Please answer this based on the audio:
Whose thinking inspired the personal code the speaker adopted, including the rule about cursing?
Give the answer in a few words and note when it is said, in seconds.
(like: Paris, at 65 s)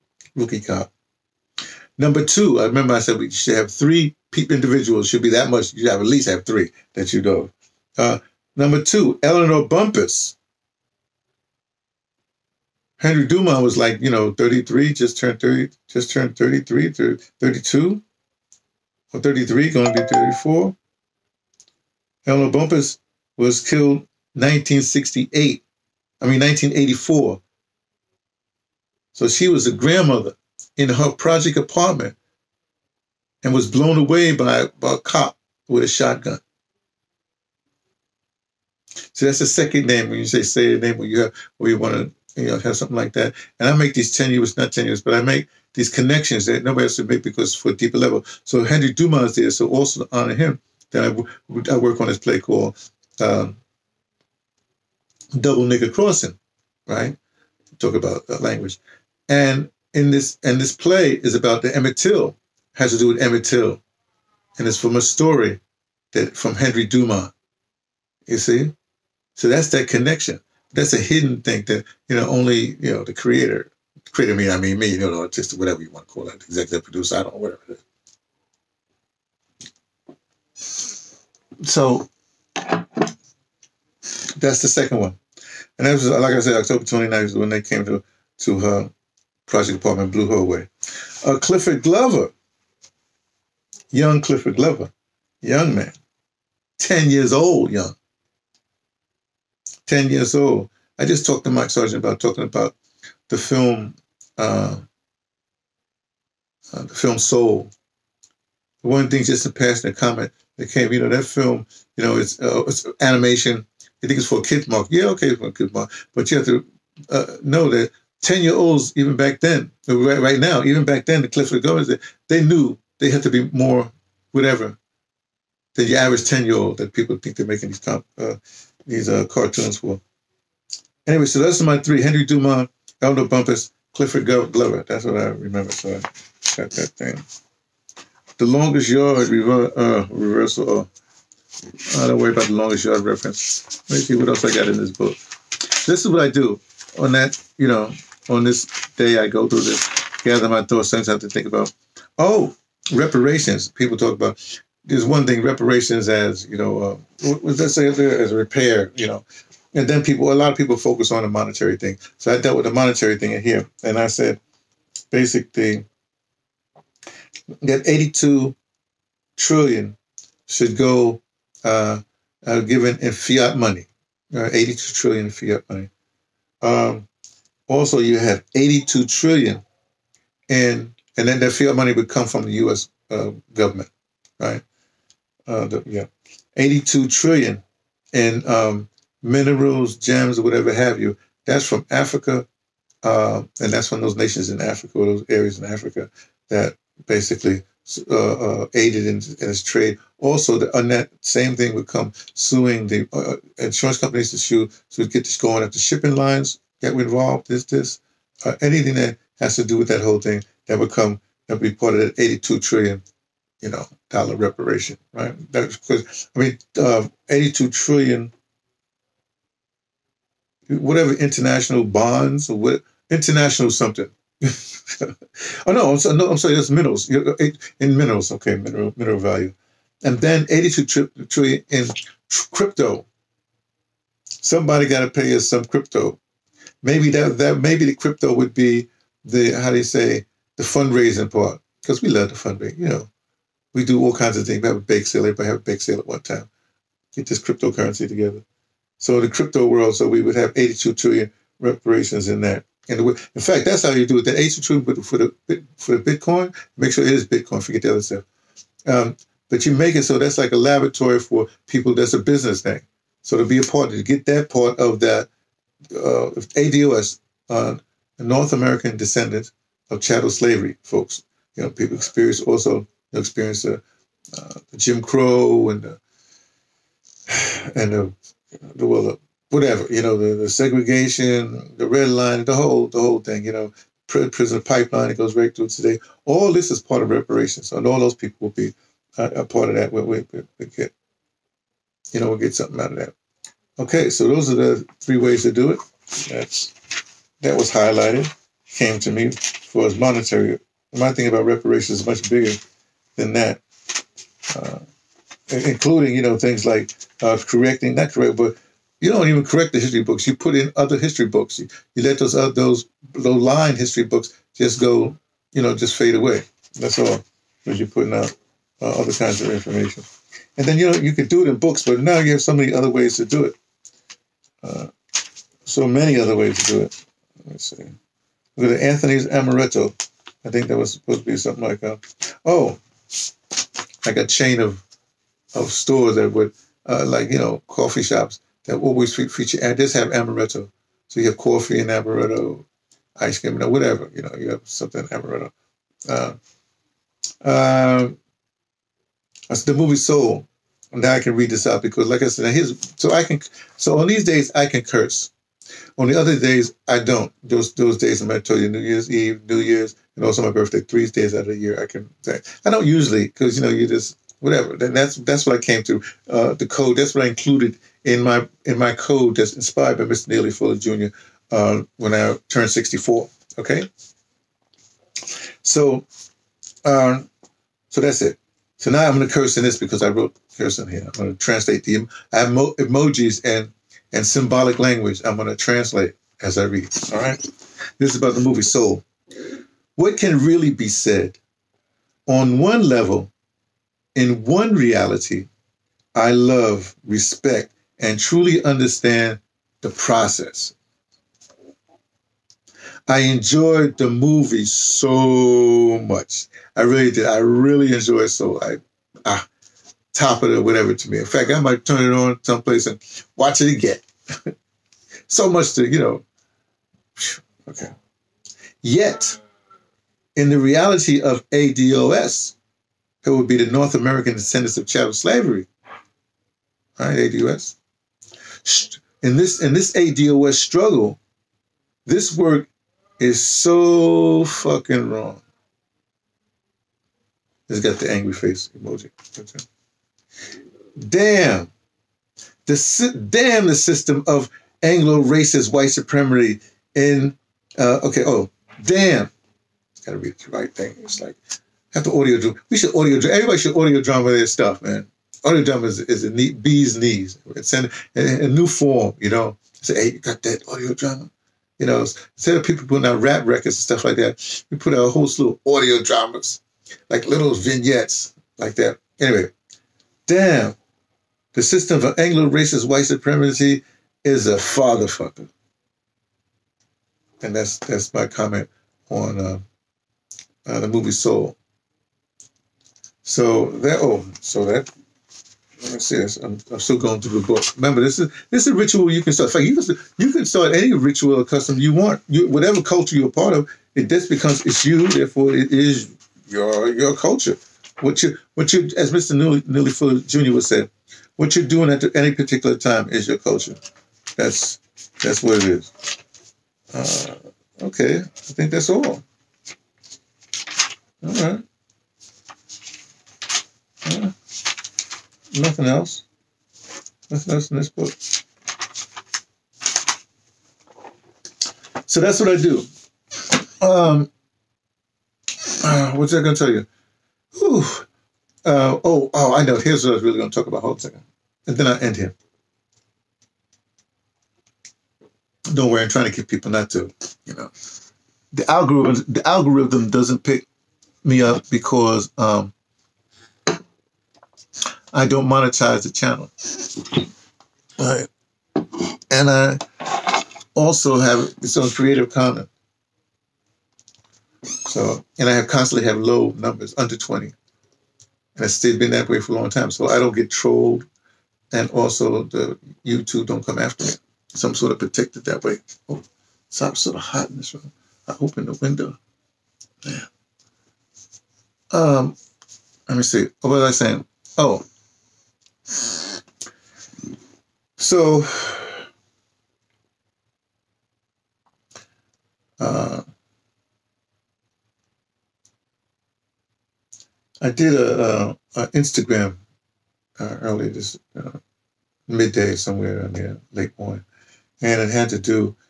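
Neely Fuller Jr., at 370 s.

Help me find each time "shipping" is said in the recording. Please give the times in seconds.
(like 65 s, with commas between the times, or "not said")
205 s.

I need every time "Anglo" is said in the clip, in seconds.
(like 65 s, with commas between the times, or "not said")
444 s, 472 s.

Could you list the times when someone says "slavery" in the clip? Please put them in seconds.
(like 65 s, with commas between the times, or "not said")
270 s, 425 s.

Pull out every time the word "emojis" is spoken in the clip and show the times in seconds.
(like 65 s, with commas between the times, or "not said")
382 s, 438 s.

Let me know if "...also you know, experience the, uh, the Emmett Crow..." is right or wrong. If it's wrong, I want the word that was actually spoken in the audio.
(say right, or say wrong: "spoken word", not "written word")
wrong: "Jim", not "Emmett".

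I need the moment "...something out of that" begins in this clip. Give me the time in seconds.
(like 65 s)
292 s.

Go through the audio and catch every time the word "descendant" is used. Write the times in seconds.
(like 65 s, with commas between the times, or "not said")
268 s, 424 s.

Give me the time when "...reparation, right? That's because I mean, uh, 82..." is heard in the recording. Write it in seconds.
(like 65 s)
214 s.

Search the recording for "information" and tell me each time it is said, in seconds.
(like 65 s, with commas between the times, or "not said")
319 s.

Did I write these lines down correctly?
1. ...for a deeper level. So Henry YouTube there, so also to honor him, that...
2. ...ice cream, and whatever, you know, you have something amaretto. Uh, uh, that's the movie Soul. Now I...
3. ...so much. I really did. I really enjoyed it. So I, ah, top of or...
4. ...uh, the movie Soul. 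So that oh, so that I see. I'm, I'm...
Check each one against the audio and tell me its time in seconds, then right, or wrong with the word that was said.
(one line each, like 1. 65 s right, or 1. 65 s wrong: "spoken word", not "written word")
1. 47 s wrong: "Dumas", not "YouTube"
2. 343 s right
3. 404 s right
4. 480 s right.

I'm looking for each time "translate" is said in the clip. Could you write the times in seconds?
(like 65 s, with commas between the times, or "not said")
381 s, 385 s.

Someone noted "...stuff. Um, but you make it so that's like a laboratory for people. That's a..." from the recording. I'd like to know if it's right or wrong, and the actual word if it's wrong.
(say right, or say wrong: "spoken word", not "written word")
right.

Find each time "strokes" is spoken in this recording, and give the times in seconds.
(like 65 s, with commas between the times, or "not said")
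not said.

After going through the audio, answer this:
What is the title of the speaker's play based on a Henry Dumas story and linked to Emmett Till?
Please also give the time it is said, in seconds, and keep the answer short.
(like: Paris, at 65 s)
Double Nigger Crossing, at 55 s.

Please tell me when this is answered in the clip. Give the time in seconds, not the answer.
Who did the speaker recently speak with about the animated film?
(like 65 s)
101 s.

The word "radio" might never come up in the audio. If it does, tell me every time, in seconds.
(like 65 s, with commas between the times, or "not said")
not said.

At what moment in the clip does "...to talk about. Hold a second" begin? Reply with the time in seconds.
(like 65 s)
530 s.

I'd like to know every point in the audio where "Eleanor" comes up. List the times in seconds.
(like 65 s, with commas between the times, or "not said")
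9 s, 22 s.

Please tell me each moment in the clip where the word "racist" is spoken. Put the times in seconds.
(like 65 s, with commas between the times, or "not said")
444 s, 472 s.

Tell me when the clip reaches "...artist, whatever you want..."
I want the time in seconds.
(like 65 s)
75 s.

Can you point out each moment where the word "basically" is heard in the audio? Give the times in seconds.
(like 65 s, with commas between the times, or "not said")
165 s, 197 s.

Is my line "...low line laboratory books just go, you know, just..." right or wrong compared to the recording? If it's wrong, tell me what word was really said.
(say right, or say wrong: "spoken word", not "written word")
wrong: "history", not "laboratory".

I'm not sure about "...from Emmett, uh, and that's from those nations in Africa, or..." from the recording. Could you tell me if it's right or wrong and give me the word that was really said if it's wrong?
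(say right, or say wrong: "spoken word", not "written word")
wrong: "Africa", not "Emmett".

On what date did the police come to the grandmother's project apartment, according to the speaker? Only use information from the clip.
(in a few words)
October 29th.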